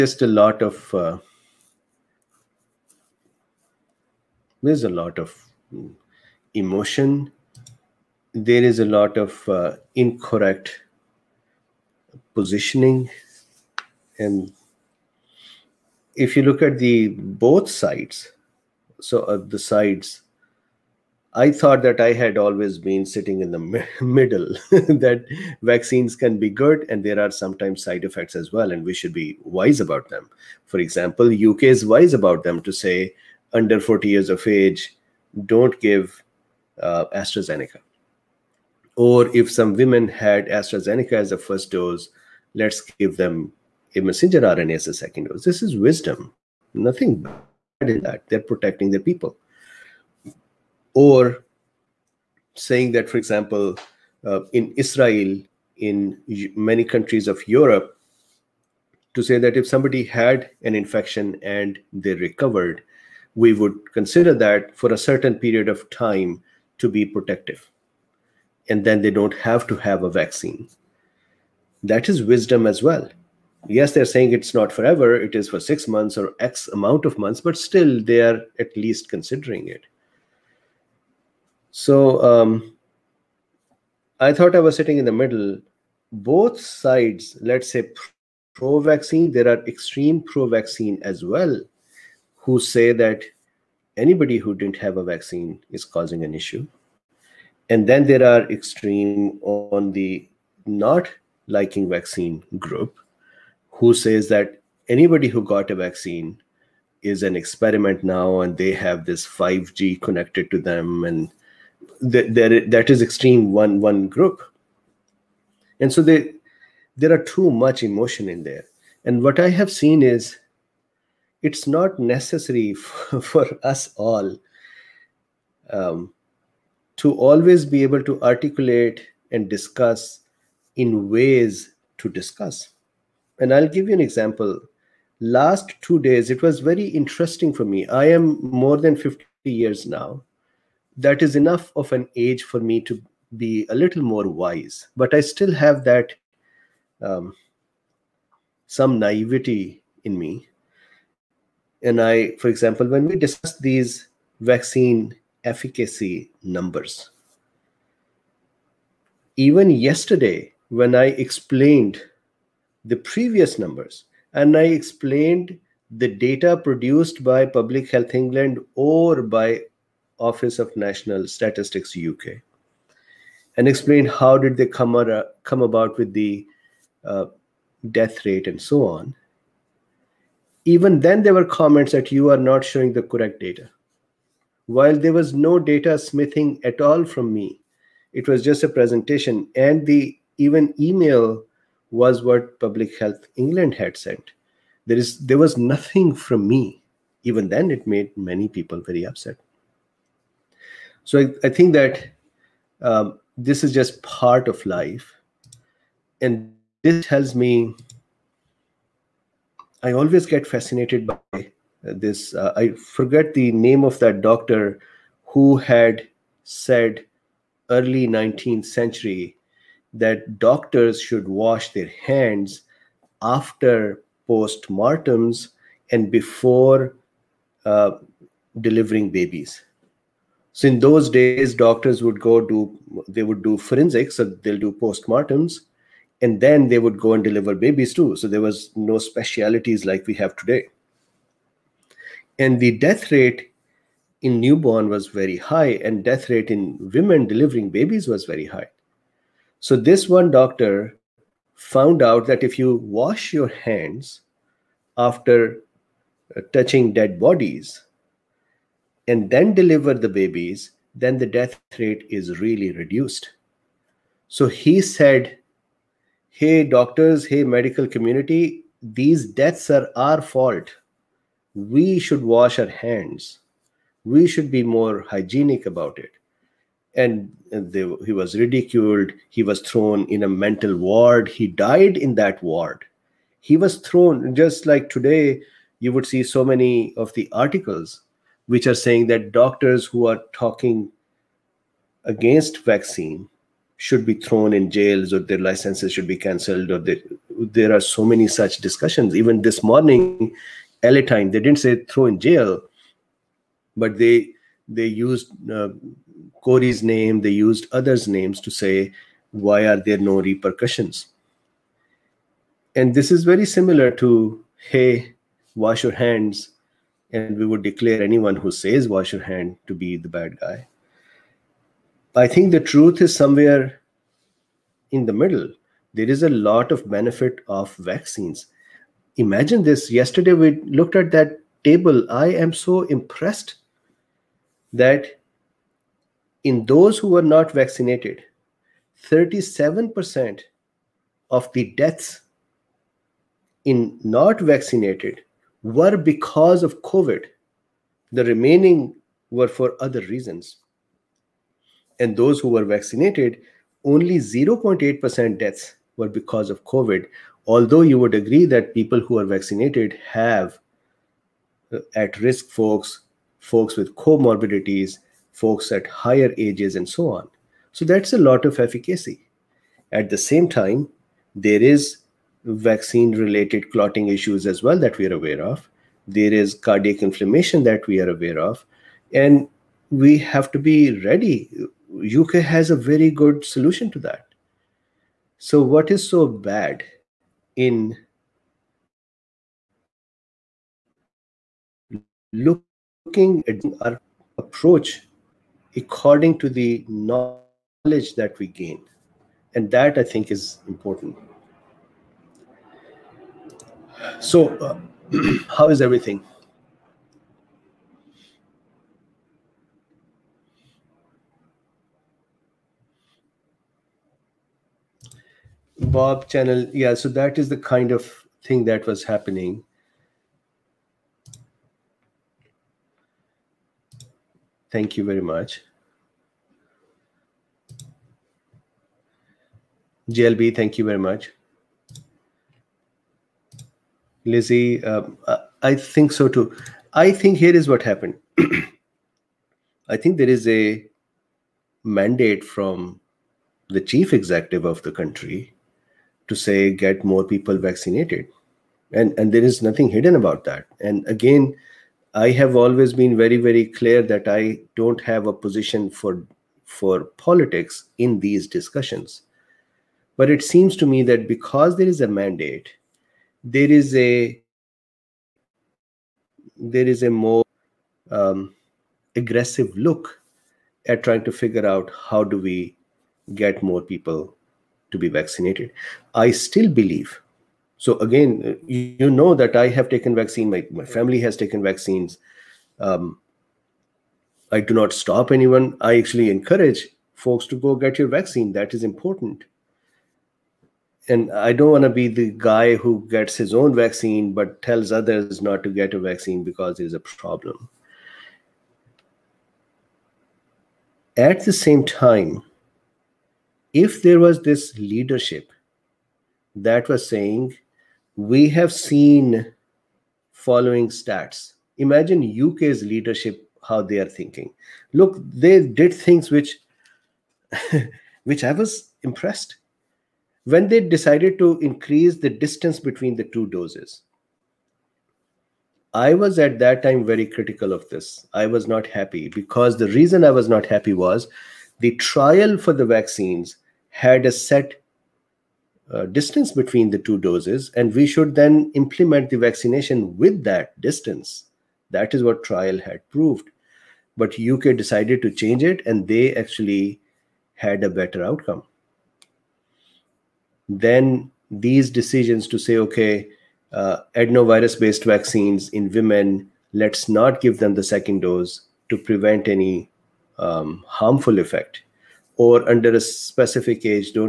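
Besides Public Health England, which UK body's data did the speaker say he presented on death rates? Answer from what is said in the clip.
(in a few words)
Office of National Statistics.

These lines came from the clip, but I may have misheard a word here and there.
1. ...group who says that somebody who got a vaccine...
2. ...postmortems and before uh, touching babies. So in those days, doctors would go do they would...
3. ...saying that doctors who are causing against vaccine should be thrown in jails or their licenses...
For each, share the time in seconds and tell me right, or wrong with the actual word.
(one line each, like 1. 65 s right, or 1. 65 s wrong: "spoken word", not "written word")
1. 102 s wrong: "anybody", not "somebody"
2. 224 s wrong: "delivering", not "touching"
3. 288 s wrong: "talking", not "causing".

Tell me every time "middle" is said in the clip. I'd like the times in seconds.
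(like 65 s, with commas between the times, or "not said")
24 s, 85 s, 325 s.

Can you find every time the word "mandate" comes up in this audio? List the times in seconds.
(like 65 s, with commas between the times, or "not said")
441 s, 462 s.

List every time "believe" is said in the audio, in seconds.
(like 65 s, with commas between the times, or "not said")
476 s.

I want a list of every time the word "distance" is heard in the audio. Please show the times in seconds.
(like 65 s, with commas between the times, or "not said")
522 s, 536 s, 540 s.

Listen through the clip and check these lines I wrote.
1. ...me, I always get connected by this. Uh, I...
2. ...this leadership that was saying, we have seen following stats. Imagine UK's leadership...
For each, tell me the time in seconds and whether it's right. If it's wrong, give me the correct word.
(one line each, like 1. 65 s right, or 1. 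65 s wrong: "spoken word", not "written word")
1. 207 s wrong: "fascinated", not "connected"
2. 504 s right.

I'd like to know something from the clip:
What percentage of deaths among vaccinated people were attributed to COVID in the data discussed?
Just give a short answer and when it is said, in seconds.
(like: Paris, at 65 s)
0.8%, at 354 s.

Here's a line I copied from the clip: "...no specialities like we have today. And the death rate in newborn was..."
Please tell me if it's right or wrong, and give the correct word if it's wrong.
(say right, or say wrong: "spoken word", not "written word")
right.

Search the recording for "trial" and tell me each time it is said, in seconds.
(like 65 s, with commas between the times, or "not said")
531 s, 542 s.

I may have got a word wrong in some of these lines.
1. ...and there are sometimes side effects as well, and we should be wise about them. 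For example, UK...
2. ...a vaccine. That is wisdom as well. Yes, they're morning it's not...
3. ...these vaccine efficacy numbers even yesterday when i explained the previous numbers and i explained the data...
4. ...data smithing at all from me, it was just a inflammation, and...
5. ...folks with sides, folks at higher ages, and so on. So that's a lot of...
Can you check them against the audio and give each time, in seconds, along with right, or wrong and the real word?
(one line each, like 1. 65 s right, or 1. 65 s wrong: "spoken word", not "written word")
1. 26 s right
2. 70 s wrong: "saying", not "morning"
3. 153 s right
4. 185 s wrong: "presentation", not "inflammation"
5. 363 s wrong: "comorbidities", not "sides".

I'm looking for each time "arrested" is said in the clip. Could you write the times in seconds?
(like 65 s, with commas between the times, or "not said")
not said.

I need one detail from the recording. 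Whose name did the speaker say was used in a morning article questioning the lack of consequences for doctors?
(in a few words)
Kory.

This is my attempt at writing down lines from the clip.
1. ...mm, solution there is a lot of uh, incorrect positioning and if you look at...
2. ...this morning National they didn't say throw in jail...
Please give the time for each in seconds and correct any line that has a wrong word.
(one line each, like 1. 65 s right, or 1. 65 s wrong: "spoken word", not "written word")
1. 5 s wrong: "emotion", not "solution"
2. 299 s wrong: "Time", not "National".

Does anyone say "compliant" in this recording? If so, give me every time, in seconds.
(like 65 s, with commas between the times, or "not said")
not said.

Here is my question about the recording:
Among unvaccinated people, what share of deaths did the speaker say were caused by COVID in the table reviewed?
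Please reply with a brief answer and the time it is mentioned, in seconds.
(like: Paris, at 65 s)
37%, at 339 s.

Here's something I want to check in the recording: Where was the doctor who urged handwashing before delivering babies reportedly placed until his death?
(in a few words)
a mental ward.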